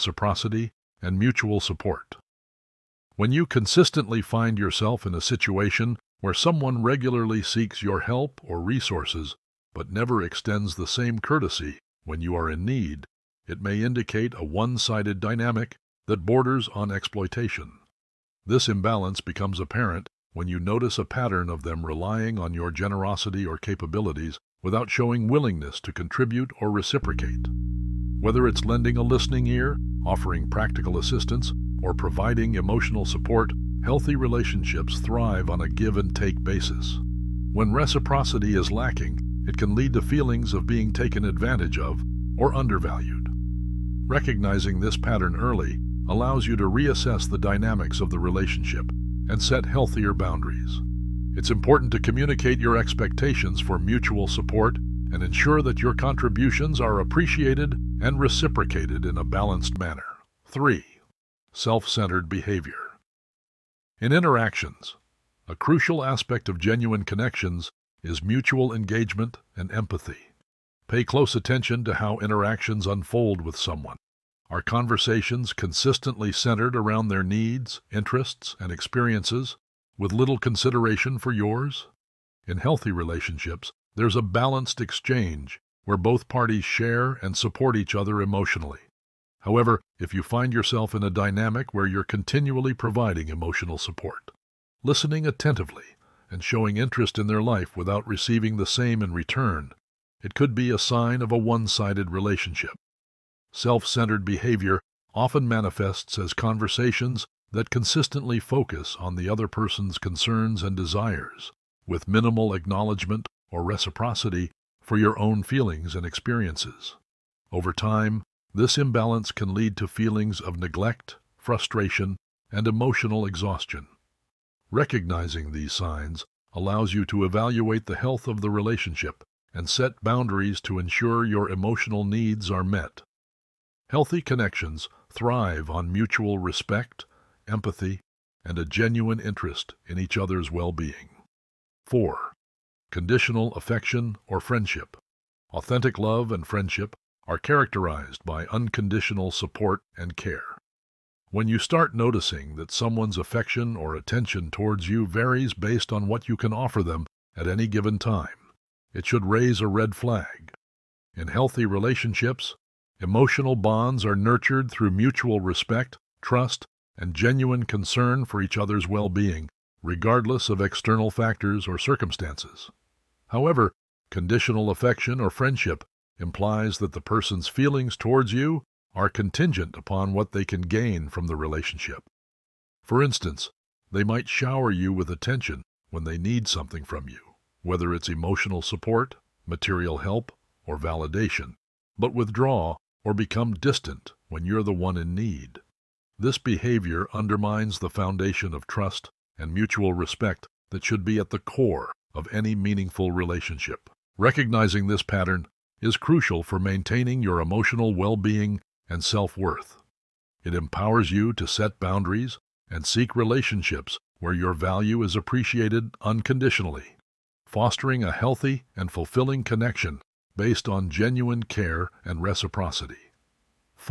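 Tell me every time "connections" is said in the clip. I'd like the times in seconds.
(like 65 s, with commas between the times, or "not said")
67 s, 134 s, 219 s.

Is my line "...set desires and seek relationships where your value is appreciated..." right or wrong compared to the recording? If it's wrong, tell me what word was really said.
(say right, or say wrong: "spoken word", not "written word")
wrong: "boundaries", not "desires".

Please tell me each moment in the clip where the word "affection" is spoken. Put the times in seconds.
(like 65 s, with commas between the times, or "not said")
143 s, 153 s, 174 s.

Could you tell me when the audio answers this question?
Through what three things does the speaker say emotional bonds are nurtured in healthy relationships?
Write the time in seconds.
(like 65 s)
164 s.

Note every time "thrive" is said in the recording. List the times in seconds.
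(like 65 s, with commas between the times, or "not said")
34 s, 135 s.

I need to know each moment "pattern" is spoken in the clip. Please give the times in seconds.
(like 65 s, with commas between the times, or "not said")
21 s, 44 s, 205 s.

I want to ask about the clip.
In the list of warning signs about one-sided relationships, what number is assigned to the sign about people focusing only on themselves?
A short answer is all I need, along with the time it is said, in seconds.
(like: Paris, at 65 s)
3, at 60 s.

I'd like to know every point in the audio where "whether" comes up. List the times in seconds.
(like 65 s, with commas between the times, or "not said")
28 s, 187 s.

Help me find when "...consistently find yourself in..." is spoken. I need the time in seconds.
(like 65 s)
3 s.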